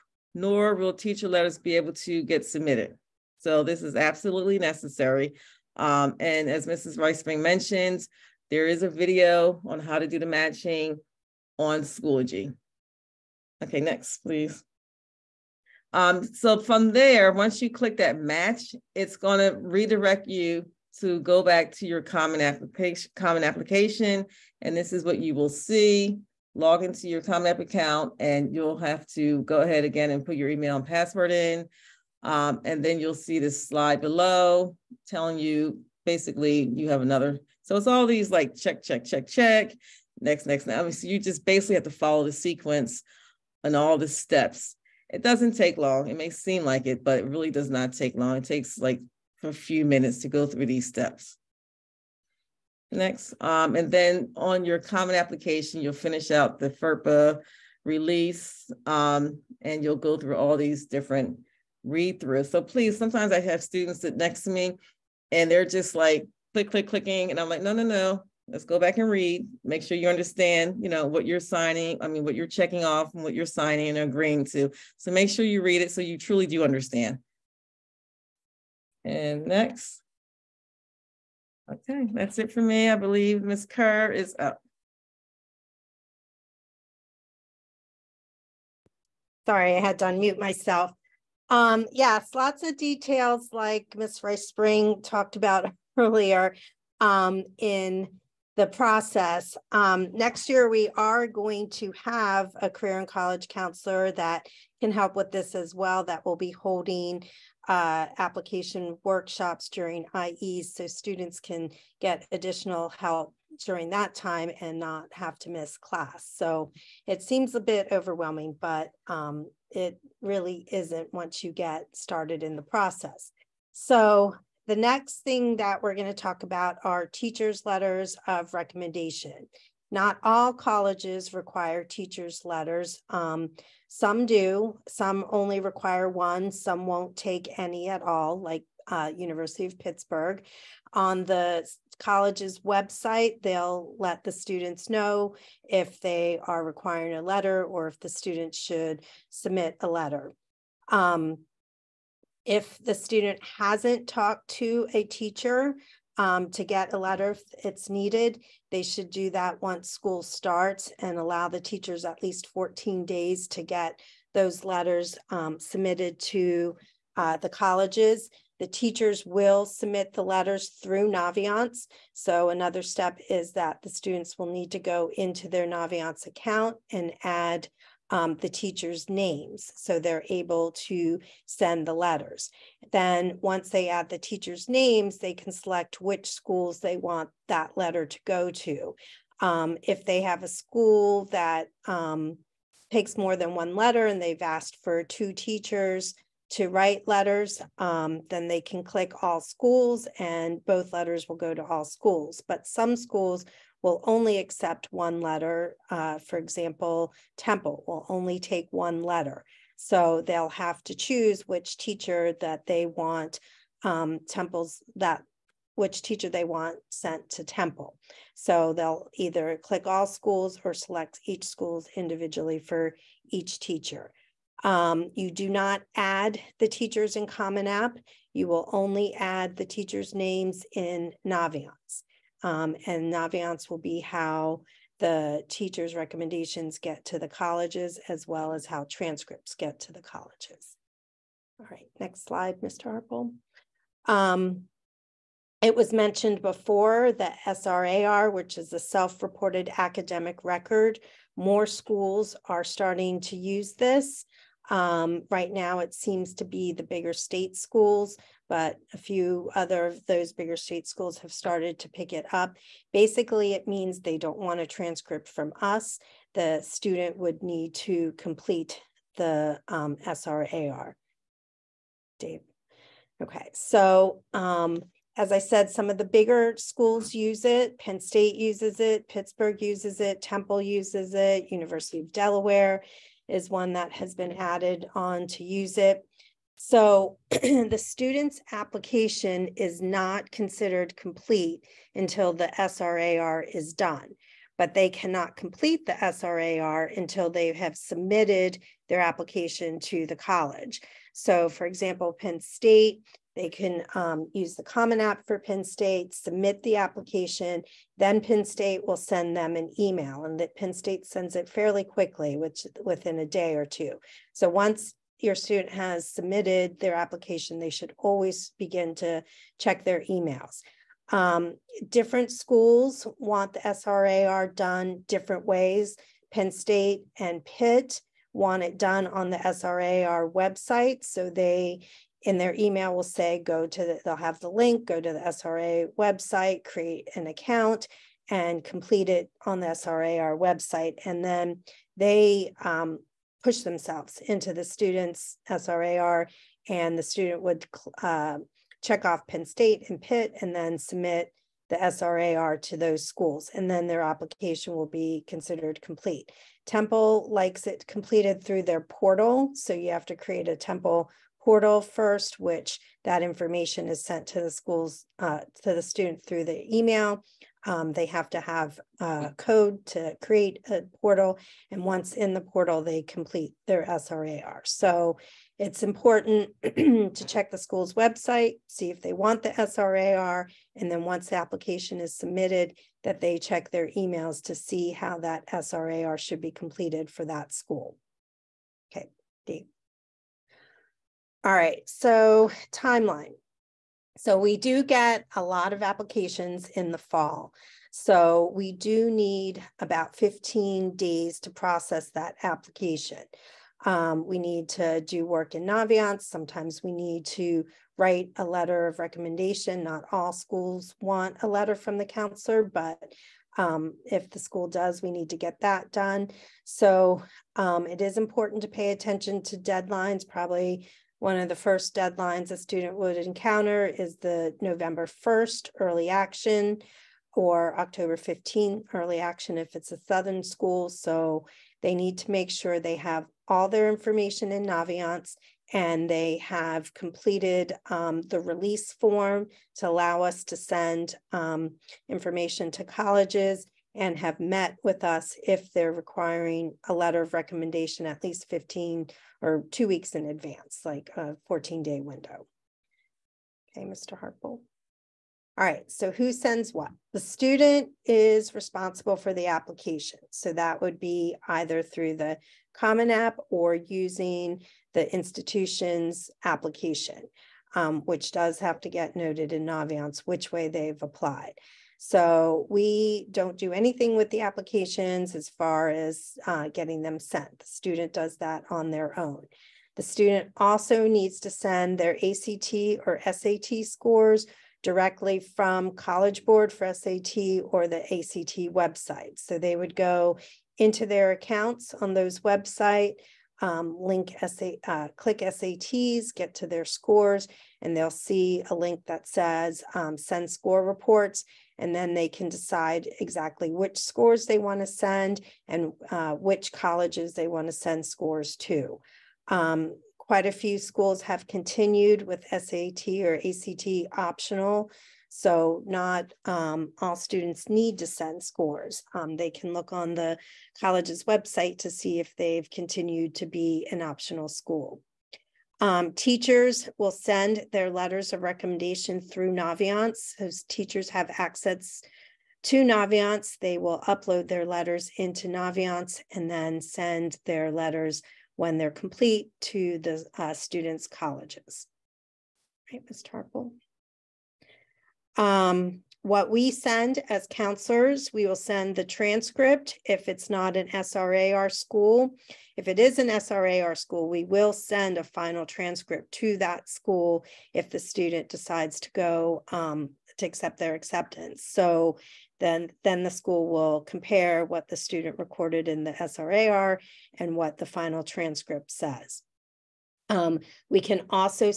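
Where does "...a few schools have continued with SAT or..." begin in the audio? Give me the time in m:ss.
8:30.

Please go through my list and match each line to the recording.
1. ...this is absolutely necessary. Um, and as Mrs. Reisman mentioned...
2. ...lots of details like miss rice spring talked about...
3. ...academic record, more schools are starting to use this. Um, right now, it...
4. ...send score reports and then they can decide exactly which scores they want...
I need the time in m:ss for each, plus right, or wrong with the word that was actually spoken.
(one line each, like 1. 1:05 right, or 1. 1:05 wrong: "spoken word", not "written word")
1. 0:03 right
2. 1:32 right
3. 4:09 right
4. 8:20 right.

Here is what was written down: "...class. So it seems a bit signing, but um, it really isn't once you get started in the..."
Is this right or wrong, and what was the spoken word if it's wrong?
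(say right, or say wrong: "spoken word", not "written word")
wrong: "overwhelming", not "signing".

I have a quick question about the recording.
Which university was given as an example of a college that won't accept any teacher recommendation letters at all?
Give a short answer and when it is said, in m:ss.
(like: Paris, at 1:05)
University of Pittsburgh, at 2:19.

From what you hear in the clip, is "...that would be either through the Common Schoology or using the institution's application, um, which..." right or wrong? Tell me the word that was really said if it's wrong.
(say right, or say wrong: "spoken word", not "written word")
wrong: "App", not "Schoology".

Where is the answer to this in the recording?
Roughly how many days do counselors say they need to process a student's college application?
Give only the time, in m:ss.
6:39.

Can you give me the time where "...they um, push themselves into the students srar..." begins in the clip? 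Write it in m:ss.
5:41.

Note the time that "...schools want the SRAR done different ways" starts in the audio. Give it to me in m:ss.
5:22.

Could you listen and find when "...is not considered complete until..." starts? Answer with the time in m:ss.
4:49.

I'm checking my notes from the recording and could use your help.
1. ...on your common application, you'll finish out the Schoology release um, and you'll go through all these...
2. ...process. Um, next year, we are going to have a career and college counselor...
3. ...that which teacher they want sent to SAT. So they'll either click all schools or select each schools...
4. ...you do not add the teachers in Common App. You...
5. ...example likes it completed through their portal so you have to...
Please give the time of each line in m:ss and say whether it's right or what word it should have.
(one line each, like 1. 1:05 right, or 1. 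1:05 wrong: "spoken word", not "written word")
1. 0:54 wrong: "FERPA", not "Schoology"
2. 1:38 right
3. 3:34 wrong: "Temple", not "SAT"
4. 3:45 right
5. 5:56 wrong: "temple", not "example".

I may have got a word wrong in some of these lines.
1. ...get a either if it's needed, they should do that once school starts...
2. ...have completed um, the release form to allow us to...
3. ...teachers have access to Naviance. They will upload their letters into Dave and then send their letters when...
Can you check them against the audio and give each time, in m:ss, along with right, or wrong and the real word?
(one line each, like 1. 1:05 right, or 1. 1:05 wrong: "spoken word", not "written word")
1. 2:36 wrong: "letter", not "either"
2. 7:16 right
3. 8:50 wrong: "Naviance", not "Dave".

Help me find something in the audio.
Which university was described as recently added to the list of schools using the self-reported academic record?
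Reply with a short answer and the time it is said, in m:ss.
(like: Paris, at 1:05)
University of Delaware, at 4:41.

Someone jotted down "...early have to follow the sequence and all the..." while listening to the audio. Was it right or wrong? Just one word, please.
wrong.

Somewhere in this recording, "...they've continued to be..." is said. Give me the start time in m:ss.
8:42.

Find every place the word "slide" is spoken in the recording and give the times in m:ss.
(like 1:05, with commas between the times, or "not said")
0:33, 4:02.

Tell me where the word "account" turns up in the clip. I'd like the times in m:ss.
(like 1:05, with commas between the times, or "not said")
0:27, 2:56, 5:37, 8:11.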